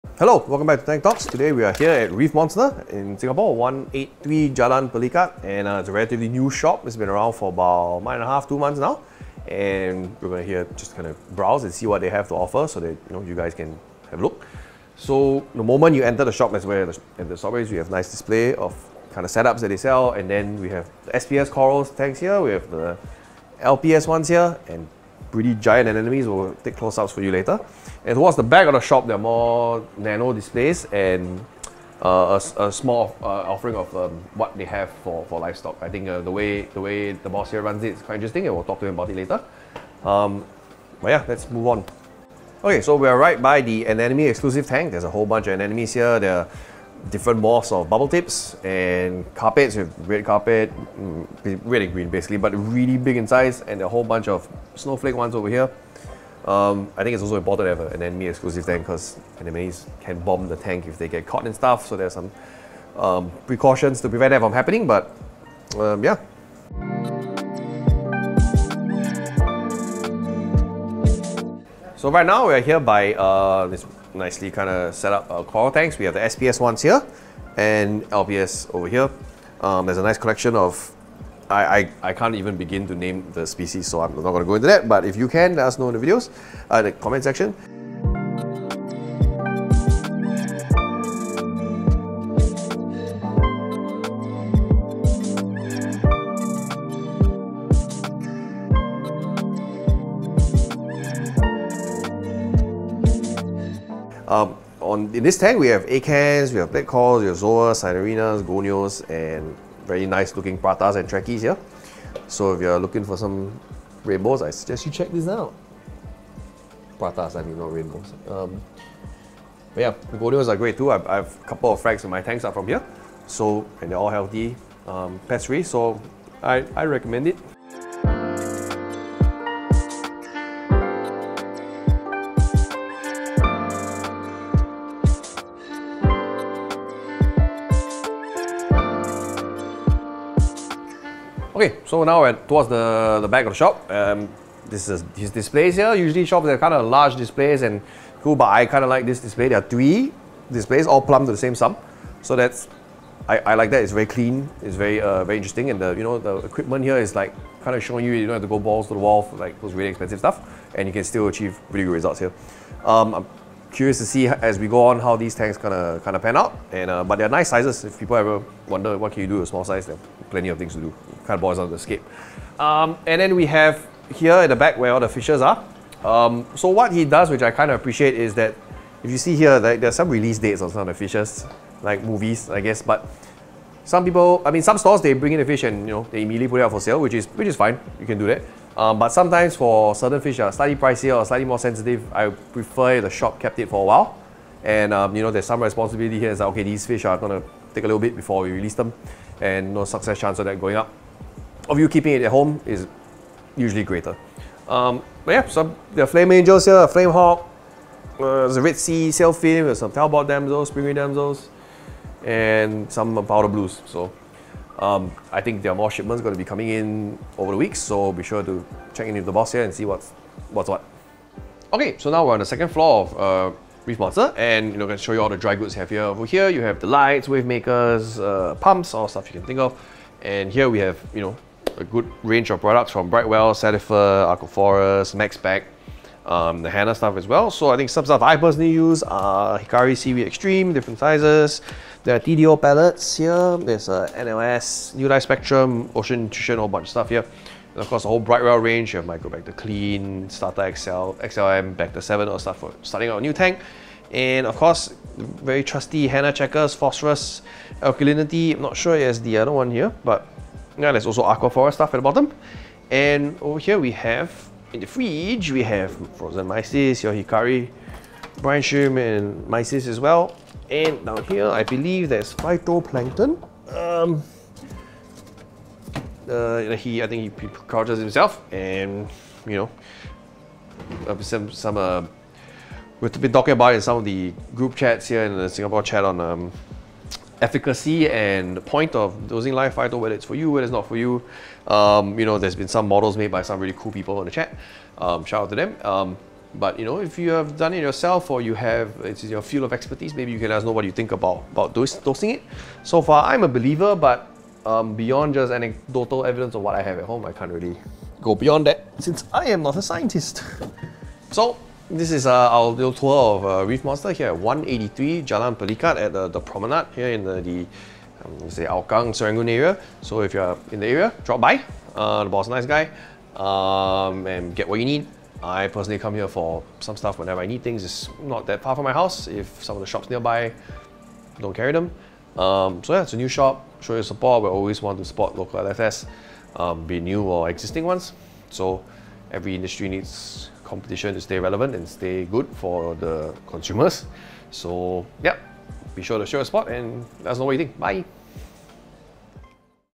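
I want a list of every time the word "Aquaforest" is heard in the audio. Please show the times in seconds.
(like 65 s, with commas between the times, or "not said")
234 s, 261 s.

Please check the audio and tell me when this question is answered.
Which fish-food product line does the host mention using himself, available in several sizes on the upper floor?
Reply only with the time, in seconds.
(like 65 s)
239 s.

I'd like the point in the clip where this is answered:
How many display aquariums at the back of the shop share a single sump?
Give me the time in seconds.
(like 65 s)
149 s.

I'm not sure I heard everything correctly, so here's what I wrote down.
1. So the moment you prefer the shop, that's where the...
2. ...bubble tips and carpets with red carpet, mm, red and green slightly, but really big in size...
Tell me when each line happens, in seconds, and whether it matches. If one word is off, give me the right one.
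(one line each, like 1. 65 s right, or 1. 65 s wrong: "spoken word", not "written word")
1. 14 s wrong: "enter", not "prefer"
2. 47 s wrong: "basically", not "slightly".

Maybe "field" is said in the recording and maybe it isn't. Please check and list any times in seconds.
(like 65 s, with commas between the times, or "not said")
299 s.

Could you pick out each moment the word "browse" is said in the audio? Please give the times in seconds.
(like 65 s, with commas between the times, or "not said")
11 s.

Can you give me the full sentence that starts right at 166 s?
And uh, but they're nice sizes.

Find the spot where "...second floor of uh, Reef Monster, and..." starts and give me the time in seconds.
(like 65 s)
222 s.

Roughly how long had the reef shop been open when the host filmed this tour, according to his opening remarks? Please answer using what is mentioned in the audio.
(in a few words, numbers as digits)
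2 months.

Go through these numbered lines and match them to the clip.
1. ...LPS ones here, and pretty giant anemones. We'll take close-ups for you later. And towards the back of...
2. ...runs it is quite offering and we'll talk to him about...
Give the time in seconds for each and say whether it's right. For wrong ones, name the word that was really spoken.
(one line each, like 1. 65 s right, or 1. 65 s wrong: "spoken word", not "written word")
1. 23 s right
2. 37 s wrong: "interesting", not "offering".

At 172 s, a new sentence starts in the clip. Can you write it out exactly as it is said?
Um, and then we have here at the back where all the fishes are.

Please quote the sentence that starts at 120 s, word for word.
I've, I've a couple of frags in my tanks are from here, so and they're all healthy, um, pest free.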